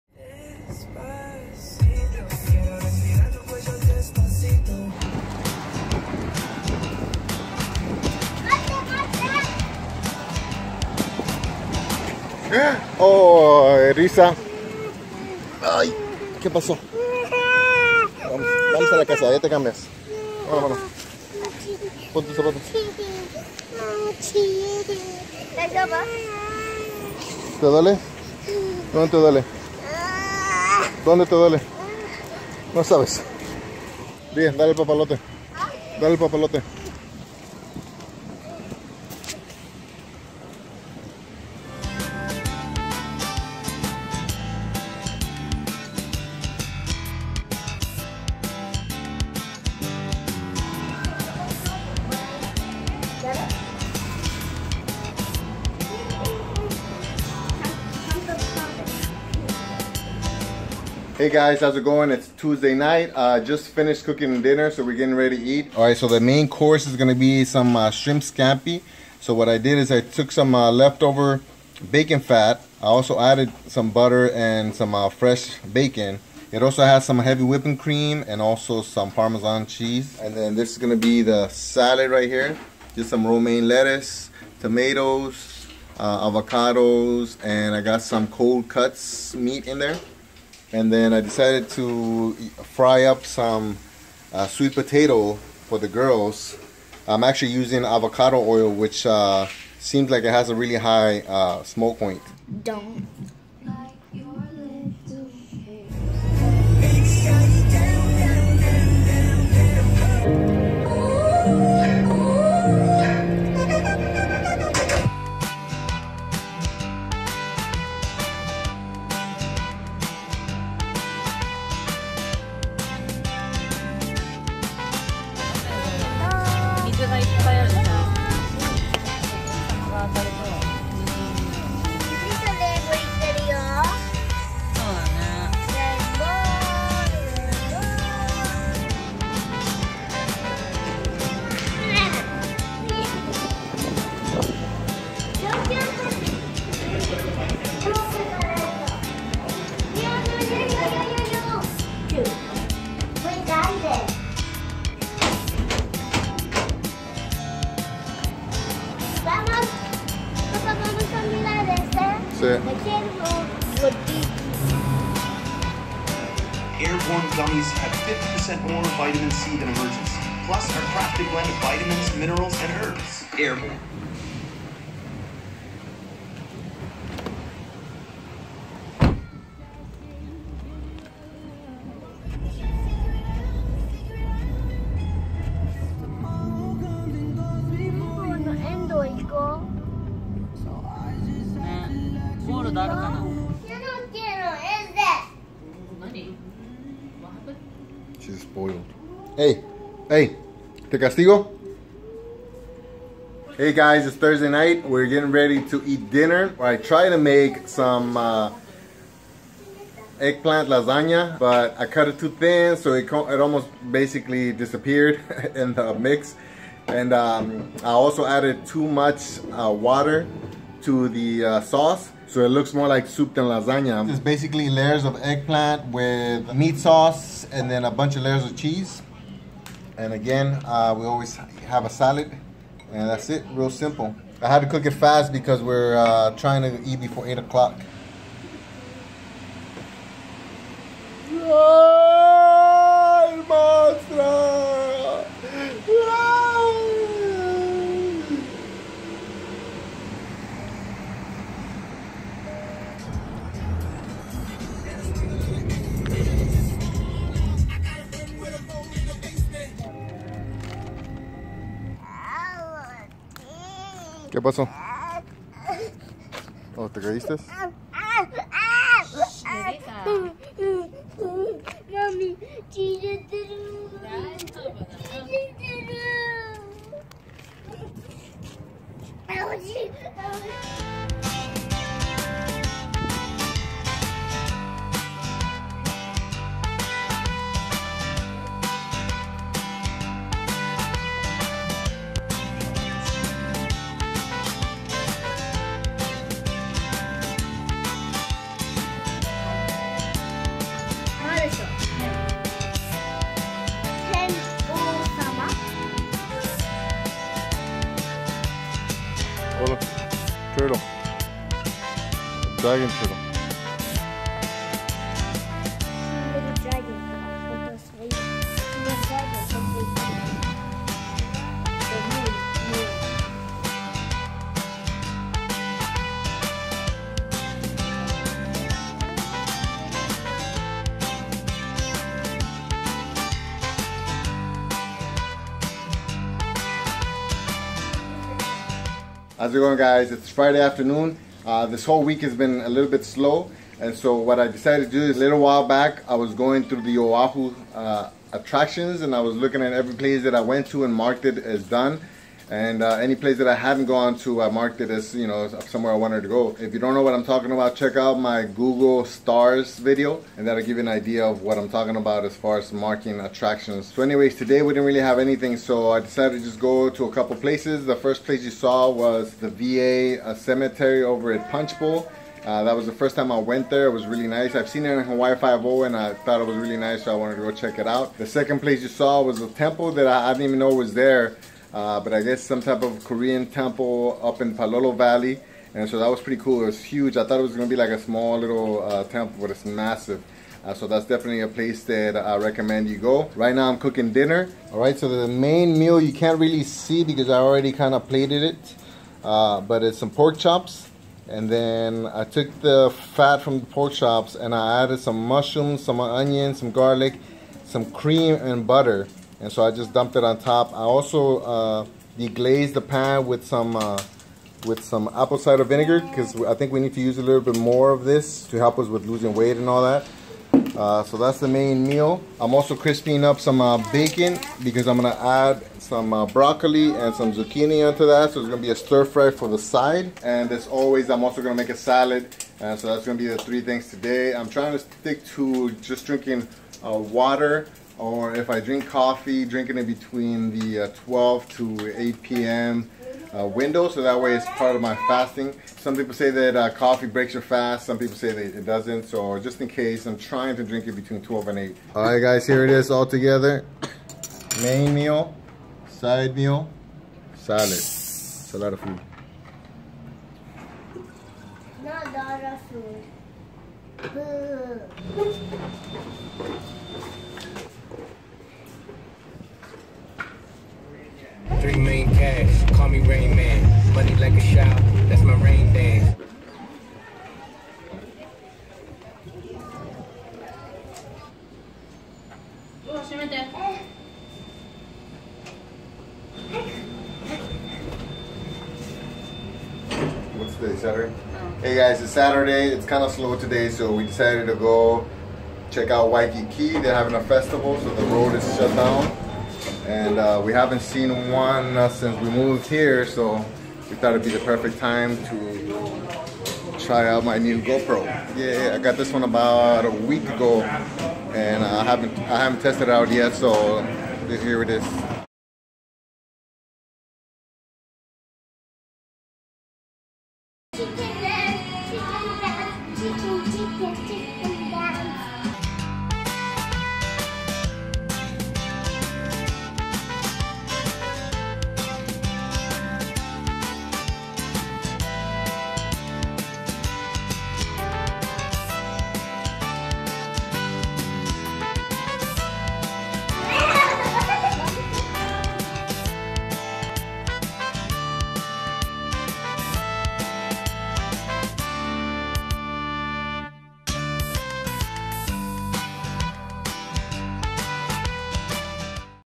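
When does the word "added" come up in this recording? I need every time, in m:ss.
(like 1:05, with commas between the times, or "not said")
1:13, 3:38, 6:44.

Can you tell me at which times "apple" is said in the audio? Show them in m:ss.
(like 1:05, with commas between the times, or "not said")
6:55.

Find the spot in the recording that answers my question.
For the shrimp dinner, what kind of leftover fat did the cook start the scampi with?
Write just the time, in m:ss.
1:11.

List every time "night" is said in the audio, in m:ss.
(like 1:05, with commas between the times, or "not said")
1:02, 3:24.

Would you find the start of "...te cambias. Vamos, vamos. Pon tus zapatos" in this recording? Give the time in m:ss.
0:19.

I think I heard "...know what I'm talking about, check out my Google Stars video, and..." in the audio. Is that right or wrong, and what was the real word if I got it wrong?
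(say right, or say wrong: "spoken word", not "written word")
right.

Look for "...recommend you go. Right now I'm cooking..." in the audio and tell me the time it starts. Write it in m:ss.
6:32.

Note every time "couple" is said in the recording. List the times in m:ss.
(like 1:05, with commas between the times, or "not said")
6:07.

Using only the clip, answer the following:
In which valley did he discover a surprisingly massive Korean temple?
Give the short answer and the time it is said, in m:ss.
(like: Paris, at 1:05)
Palolo Valley, at 6:24.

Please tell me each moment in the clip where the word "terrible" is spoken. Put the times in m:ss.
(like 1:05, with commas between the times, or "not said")
not said.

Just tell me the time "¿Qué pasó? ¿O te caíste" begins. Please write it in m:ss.
4:24.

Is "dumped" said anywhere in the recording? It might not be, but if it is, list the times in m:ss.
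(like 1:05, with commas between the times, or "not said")
6:49.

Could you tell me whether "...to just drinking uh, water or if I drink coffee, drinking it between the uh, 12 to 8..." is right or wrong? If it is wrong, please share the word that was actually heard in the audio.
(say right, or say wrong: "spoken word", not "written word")
right.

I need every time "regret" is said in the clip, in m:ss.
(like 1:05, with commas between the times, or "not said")
not said.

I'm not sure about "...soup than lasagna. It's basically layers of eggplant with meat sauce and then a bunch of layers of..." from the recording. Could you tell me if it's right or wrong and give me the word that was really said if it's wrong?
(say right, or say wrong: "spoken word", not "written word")
right.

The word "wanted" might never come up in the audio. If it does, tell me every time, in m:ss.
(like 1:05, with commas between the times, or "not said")
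5:55, 6:17.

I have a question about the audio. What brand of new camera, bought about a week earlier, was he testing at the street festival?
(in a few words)
GoPro.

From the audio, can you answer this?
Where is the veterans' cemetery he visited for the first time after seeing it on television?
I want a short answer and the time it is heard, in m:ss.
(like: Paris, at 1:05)
Punchbowl, at 6:11.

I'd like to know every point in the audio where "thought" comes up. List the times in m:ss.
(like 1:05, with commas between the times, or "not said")
6:16, 6:27, 8:23.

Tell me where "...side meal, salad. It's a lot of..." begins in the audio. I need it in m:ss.
7:35.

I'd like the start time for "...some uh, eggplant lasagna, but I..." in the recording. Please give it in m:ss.
3:27.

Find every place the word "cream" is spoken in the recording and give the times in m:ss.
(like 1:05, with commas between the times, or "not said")
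1:17, 6:47.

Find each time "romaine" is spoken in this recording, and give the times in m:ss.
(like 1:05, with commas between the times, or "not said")
1:23.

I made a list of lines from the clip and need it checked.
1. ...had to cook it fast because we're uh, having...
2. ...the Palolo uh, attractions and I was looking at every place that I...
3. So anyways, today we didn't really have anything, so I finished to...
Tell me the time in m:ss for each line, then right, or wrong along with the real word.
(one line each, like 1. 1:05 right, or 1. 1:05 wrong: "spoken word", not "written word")
1. 3:54 wrong: "trying", not "having"
2. 5:46 wrong: "Oahu", not "Palolo"
3. 6:03 wrong: "decided", not "finished".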